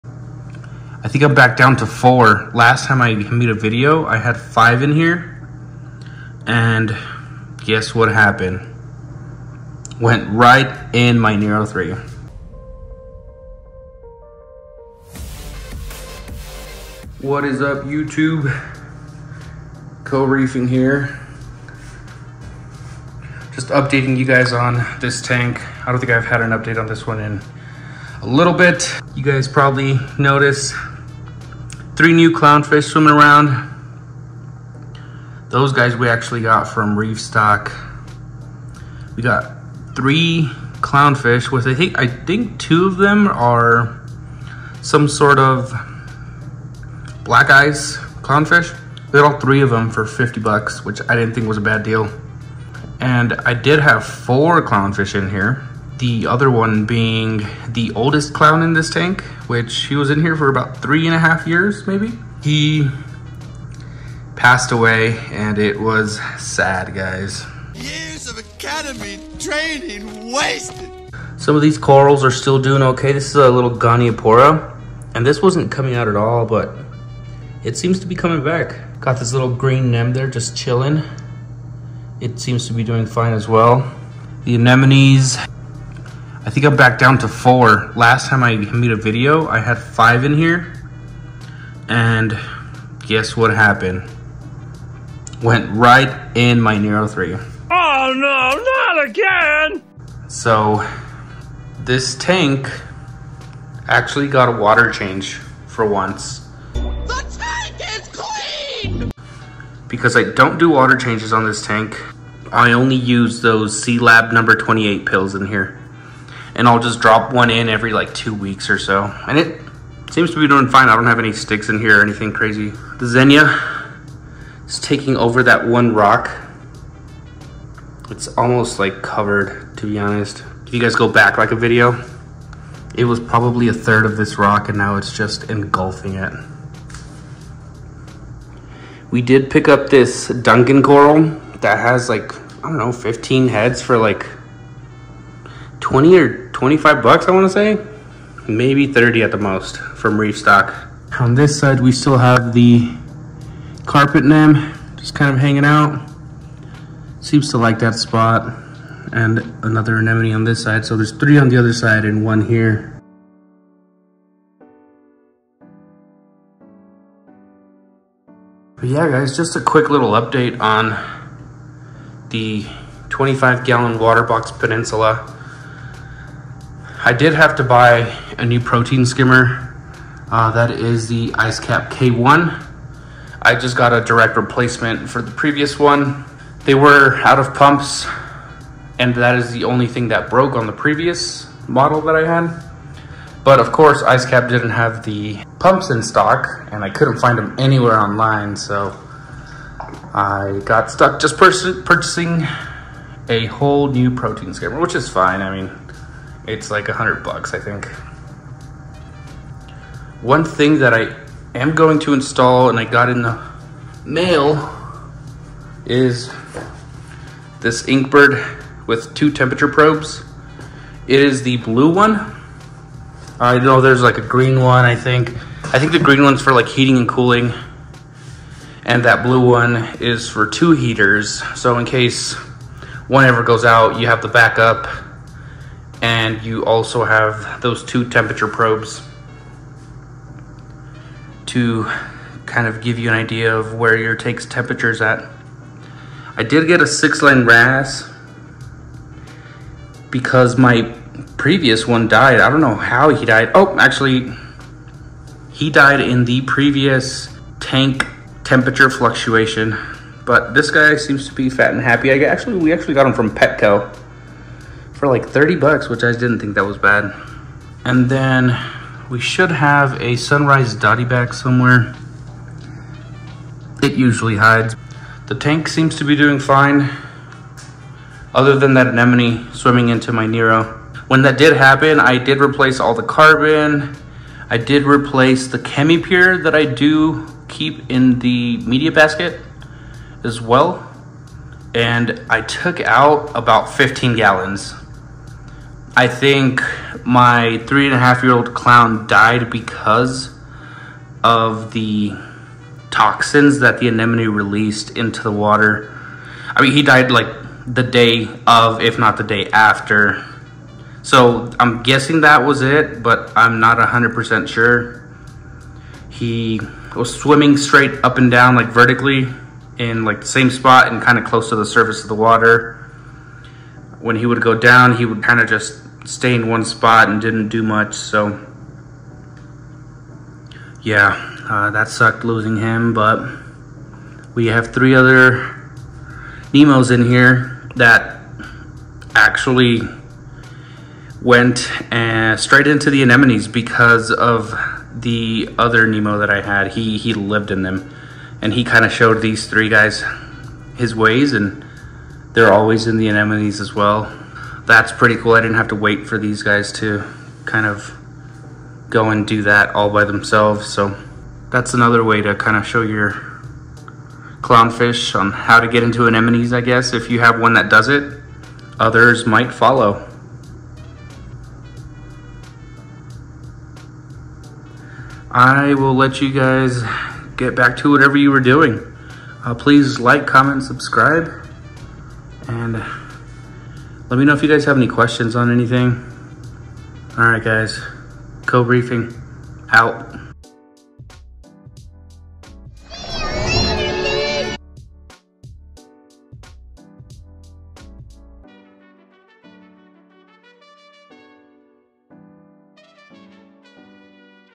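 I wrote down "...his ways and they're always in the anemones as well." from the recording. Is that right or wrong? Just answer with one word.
right.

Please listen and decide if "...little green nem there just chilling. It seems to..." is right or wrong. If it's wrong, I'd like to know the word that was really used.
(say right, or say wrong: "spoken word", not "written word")
right.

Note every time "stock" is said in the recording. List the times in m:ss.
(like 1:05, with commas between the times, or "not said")
0:37, 2:30, 3:16.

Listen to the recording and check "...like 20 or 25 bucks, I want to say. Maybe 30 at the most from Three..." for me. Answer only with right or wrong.
wrong.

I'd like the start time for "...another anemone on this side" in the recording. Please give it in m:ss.
2:39.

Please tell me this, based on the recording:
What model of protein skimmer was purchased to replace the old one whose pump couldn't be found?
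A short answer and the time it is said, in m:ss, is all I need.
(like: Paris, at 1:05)
Ice Cap K1, at 3:01.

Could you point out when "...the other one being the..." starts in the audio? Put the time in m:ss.
0:56.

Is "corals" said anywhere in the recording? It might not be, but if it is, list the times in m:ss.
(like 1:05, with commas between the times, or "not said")
1:11, 2:20.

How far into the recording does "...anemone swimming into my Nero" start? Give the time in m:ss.
4:38.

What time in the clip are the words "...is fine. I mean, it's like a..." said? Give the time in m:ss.
3:24.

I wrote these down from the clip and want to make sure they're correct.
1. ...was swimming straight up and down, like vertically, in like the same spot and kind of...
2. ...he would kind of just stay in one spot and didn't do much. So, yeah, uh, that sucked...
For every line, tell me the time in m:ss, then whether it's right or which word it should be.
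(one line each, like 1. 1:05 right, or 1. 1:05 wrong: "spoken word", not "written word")
1. 5:16 right
2. 5:24 right.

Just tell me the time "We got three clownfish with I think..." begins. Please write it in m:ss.
0:39.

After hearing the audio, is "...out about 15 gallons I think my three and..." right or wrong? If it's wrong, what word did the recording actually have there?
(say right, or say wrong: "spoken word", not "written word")
right.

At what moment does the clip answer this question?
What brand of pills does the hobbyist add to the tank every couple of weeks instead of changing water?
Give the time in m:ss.
1:53.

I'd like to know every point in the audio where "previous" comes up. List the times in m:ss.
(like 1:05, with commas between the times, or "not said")
3:05, 3:10, 4:11, 4:16.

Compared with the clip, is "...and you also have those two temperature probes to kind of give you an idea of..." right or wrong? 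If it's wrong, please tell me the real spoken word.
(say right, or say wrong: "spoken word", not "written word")
right.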